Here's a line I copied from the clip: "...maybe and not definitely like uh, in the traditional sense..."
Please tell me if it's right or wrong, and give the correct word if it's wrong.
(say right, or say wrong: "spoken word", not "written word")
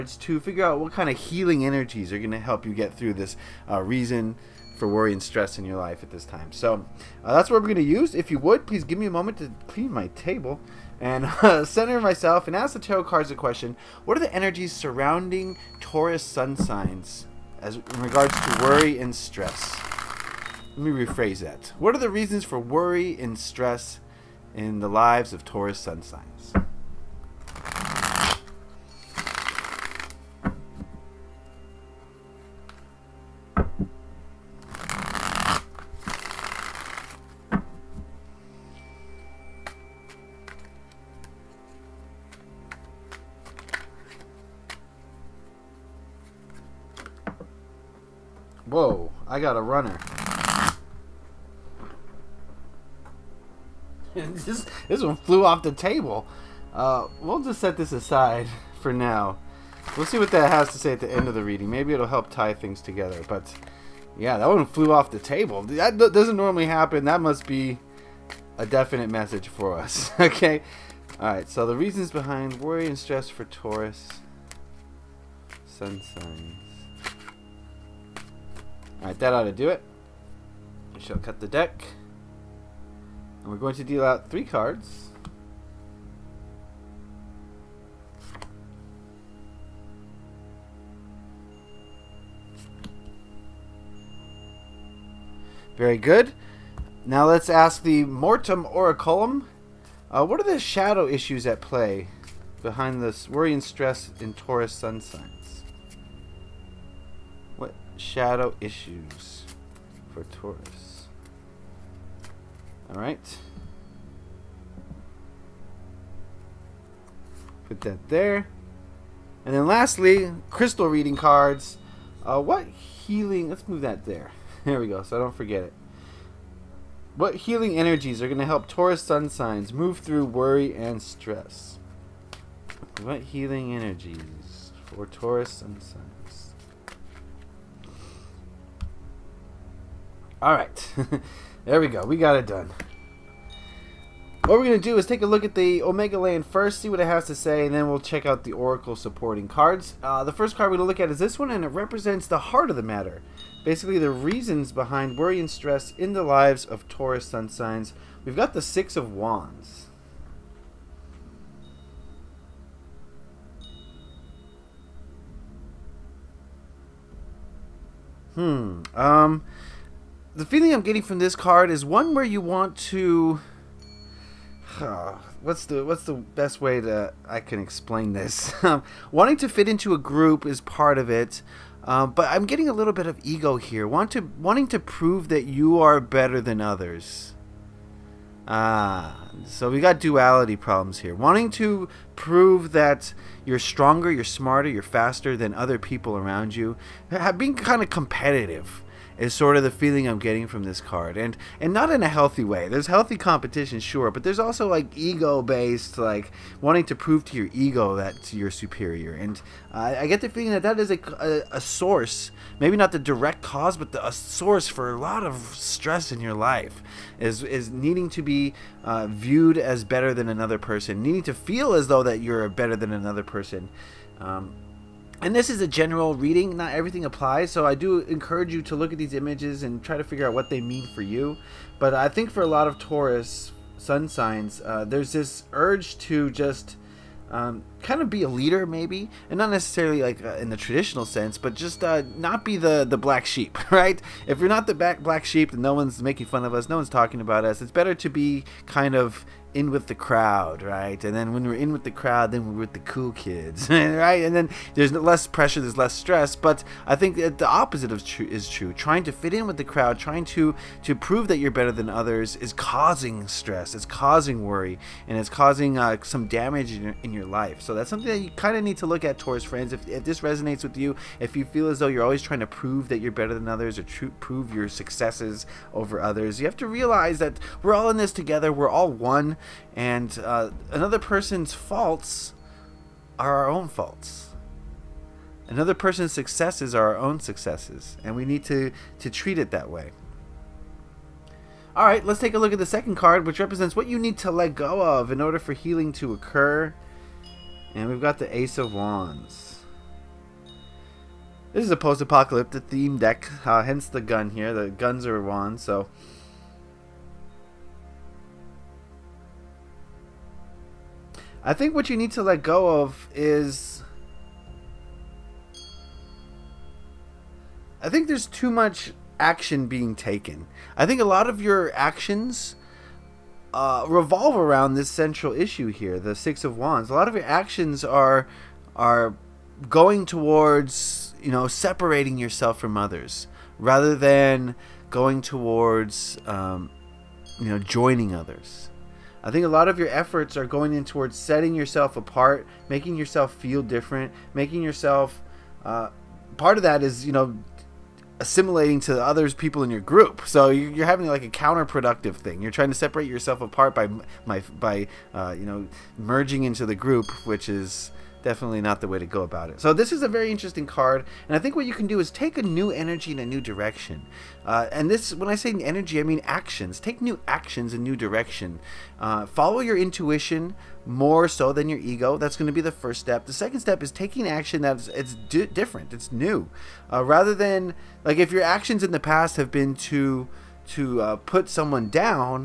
wrong: "necessarily", not "definitely".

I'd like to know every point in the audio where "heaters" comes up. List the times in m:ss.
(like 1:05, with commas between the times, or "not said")
not said.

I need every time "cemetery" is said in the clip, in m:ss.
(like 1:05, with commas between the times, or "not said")
not said.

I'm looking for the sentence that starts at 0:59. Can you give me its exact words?
We'll see what that has to say at the end of the reading.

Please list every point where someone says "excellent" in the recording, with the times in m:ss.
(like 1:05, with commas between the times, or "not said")
not said.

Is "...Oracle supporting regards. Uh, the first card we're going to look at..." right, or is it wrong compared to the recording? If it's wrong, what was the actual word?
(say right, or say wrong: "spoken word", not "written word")
wrong: "cards", not "regards".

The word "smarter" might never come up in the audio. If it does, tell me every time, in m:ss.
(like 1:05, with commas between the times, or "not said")
3:14.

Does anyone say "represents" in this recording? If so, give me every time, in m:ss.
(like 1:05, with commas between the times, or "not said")
2:31, 4:53.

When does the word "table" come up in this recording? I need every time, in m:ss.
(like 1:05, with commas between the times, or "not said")
0:10, 0:55, 1:05.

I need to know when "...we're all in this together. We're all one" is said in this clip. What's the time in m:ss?
4:37.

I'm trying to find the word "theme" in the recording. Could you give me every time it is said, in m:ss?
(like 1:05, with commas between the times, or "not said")
5:02.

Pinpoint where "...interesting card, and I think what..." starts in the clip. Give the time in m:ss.
6:00.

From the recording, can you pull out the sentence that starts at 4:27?
So that's something that you kind of need to look at, Taurus friends.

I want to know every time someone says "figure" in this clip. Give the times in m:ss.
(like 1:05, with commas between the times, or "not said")
0:00, 3:50.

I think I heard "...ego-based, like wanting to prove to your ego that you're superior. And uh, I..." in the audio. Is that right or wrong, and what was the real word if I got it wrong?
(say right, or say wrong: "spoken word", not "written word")
right.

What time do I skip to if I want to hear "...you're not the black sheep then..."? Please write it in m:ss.
4:04.